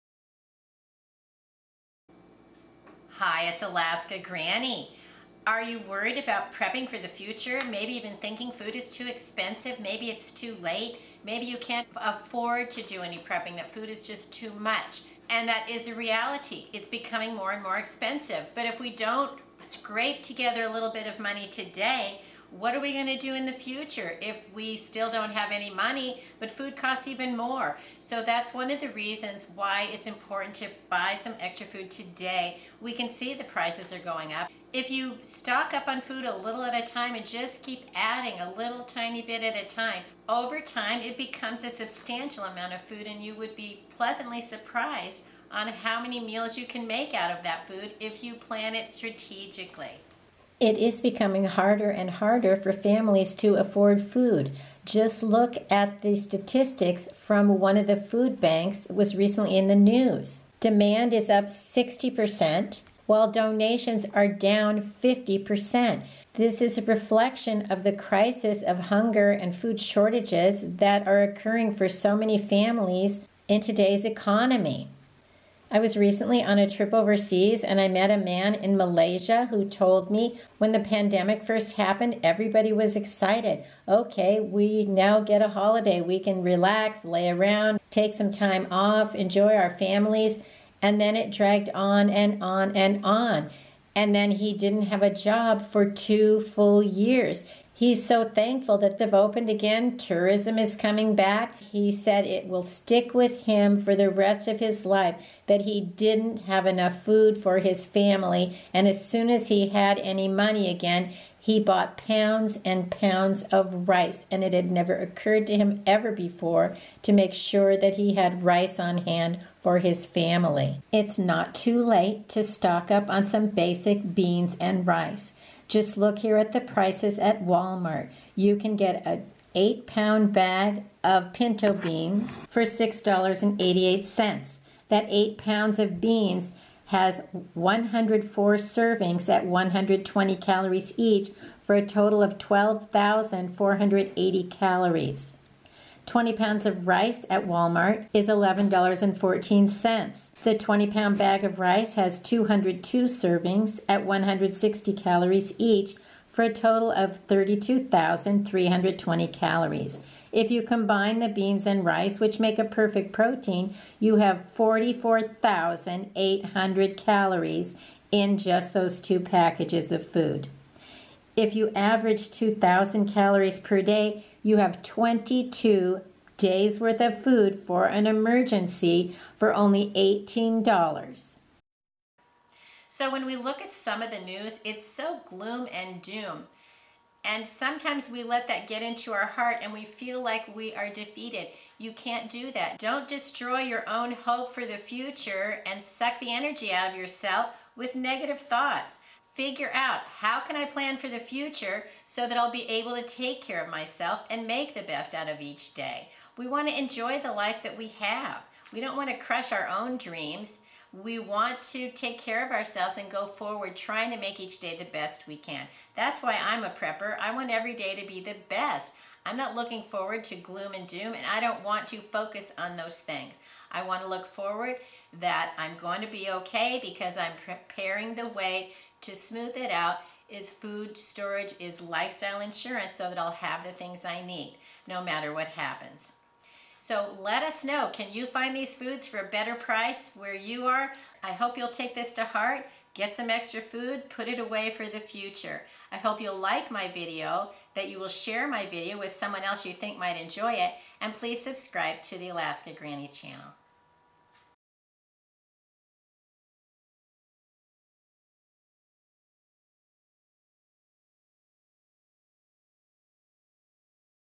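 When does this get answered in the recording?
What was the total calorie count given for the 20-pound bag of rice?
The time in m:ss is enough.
2:37.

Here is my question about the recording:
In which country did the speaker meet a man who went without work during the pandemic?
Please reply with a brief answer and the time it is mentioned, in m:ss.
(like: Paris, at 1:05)
Malaysia, at 1:18.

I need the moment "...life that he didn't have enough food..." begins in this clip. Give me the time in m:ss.
1:44.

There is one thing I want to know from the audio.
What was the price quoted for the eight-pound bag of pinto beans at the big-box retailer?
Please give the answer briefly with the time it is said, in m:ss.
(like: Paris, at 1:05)
$6.88, at 2:12.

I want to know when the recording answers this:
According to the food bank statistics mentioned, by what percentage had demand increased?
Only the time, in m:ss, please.
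1:01.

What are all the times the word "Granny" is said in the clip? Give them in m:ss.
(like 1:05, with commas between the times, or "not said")
0:04, 4:12.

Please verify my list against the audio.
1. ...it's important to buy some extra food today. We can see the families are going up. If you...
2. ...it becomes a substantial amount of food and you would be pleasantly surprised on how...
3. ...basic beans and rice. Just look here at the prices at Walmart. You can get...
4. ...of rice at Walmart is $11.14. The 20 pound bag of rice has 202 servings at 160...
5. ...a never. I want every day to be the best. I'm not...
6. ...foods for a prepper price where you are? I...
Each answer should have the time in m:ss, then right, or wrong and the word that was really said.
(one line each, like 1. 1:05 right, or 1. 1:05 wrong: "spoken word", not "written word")
1. 0:29 wrong: "prices", not "families"
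2. 0:41 right
3. 2:03 right
4. 2:26 right
5. 3:36 wrong: "prepper", not "never"
6. 3:58 wrong: "better", not "prepper".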